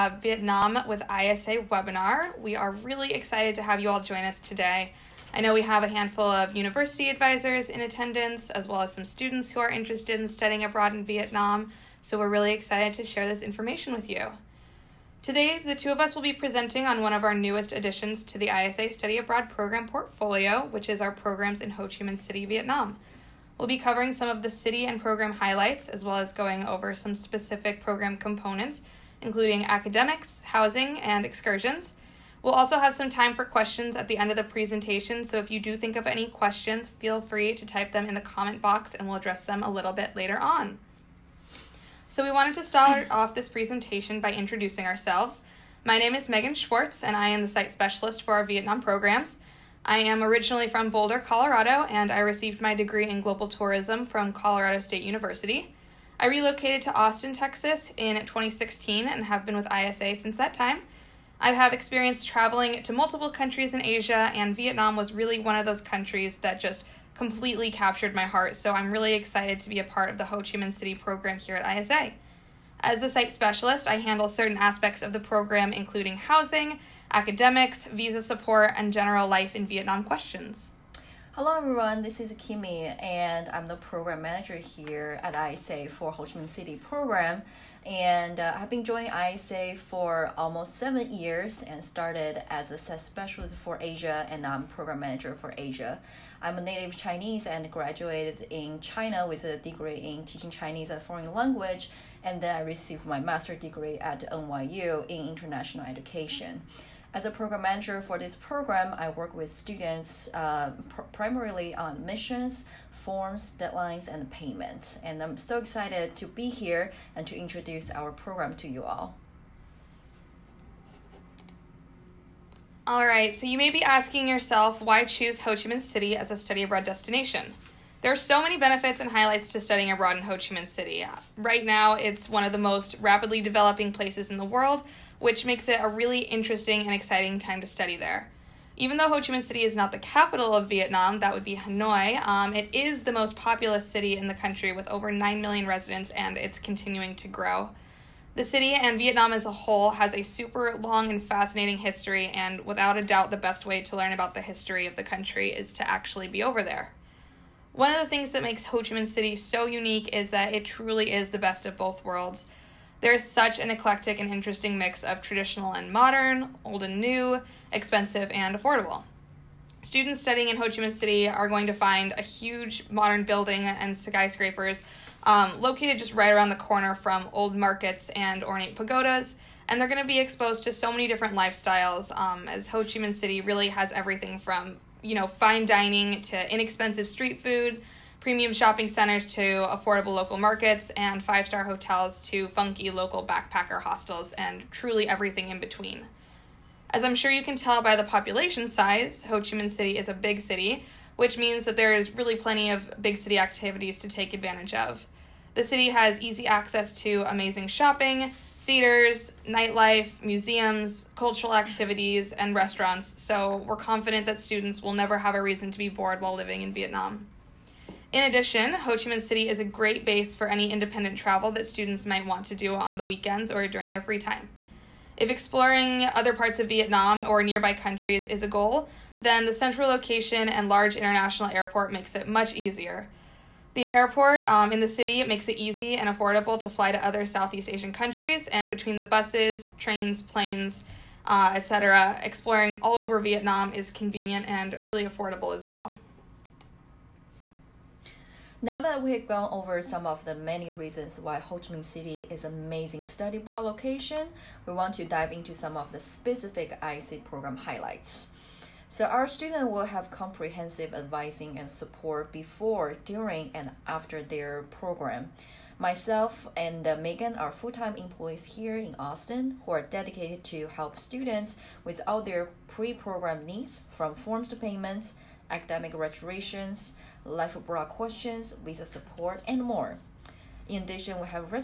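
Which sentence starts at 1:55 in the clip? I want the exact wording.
And I'm so excited to be here and to introduce our program to you all.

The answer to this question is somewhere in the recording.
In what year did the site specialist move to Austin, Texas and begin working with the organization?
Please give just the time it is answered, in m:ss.
0:58.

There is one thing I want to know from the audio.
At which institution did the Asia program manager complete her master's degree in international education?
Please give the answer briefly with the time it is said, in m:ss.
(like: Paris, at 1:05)
NYU, at 1:44.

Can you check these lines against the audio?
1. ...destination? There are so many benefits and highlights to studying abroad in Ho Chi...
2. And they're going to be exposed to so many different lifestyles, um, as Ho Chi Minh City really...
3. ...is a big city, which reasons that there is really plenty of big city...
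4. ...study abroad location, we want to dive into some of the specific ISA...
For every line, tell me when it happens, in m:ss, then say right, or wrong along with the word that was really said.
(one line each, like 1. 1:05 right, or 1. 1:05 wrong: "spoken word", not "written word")
1. 2:06 right
2. 2:59 right
3. 3:19 wrong: "means", not "reasons"
4. 4:13 right.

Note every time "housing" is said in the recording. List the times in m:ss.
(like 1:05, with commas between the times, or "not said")
0:30, 1:16.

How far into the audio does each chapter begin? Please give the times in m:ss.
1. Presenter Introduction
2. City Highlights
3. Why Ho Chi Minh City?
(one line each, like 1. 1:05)
1. 0:41
2. 2:01
3. 4:06.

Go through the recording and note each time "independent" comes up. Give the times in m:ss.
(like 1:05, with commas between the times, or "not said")
3:40.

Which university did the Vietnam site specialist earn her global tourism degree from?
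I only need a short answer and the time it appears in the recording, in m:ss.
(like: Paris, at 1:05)
Colorado State University, at 0:54.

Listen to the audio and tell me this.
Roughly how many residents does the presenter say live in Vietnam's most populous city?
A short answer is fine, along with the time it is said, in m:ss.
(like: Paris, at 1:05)
over 9 million, at 2:24.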